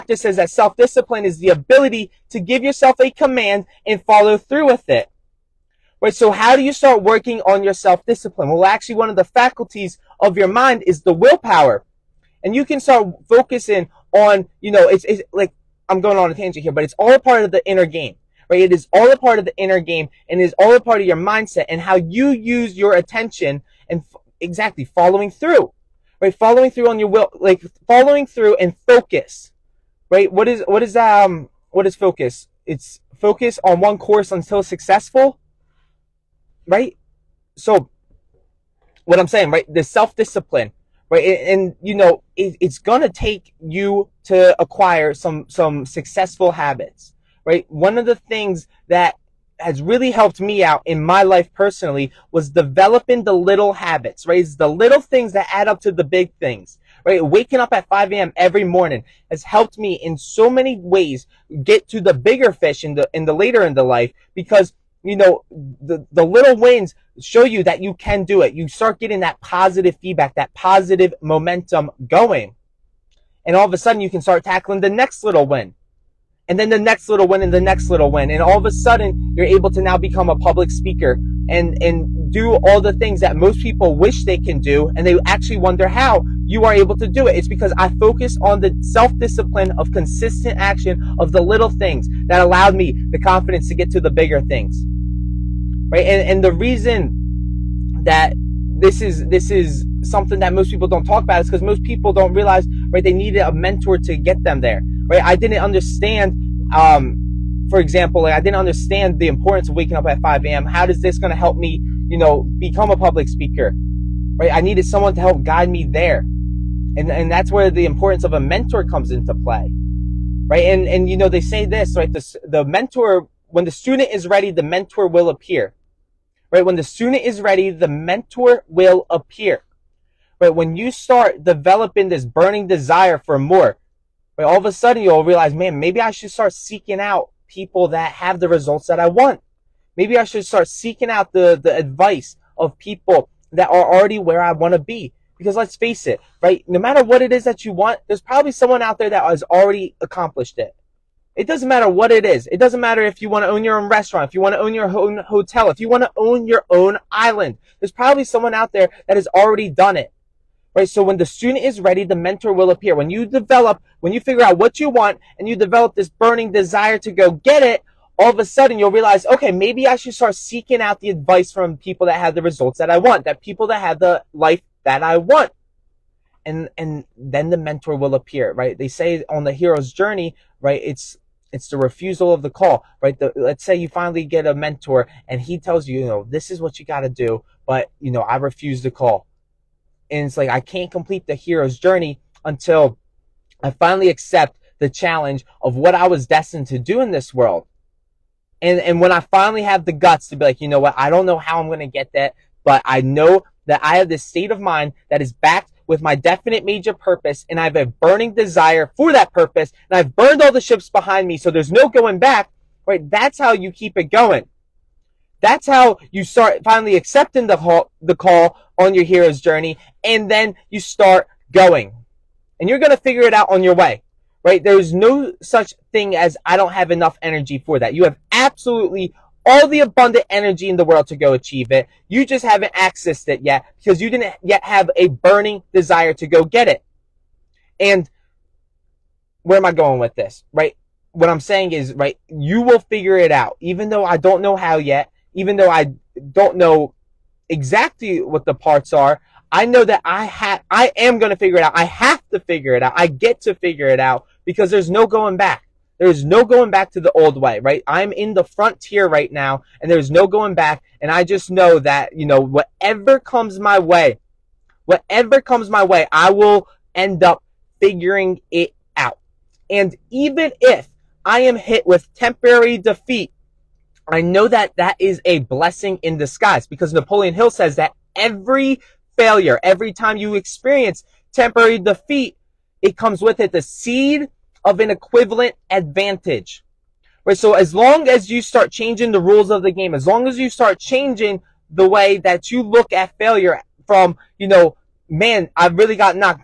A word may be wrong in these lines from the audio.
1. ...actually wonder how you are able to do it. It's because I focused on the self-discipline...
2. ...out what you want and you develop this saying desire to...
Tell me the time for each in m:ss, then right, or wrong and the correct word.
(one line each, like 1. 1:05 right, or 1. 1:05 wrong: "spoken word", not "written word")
1. 1:25 right
2. 2:44 wrong: "burning", not "saying".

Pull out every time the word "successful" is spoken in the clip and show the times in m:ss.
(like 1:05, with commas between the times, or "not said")
0:34, 0:45.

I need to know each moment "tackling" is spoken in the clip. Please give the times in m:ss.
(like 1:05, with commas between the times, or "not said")
1:14.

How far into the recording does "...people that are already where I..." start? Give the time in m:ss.
2:22.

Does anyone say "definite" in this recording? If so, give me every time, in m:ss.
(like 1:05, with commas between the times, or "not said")
3:26.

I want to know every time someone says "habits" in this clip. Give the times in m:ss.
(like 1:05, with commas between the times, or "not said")
0:46, 0:53.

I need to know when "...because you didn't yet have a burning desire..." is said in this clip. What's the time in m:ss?
3:53.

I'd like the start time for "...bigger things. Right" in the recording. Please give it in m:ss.
1:34.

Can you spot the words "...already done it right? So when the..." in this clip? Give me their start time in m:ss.
2:39.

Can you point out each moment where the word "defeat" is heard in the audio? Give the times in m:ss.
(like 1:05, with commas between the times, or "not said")
4:32, 4:41.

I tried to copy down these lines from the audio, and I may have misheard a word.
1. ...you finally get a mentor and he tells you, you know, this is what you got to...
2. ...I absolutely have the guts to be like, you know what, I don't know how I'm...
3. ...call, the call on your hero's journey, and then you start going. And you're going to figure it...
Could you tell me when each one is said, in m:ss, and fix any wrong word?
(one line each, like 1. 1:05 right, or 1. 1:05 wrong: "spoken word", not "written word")
1. 3:03 right
2. 3:19 wrong: "finally", not "absolutely"
3. 3:37 right.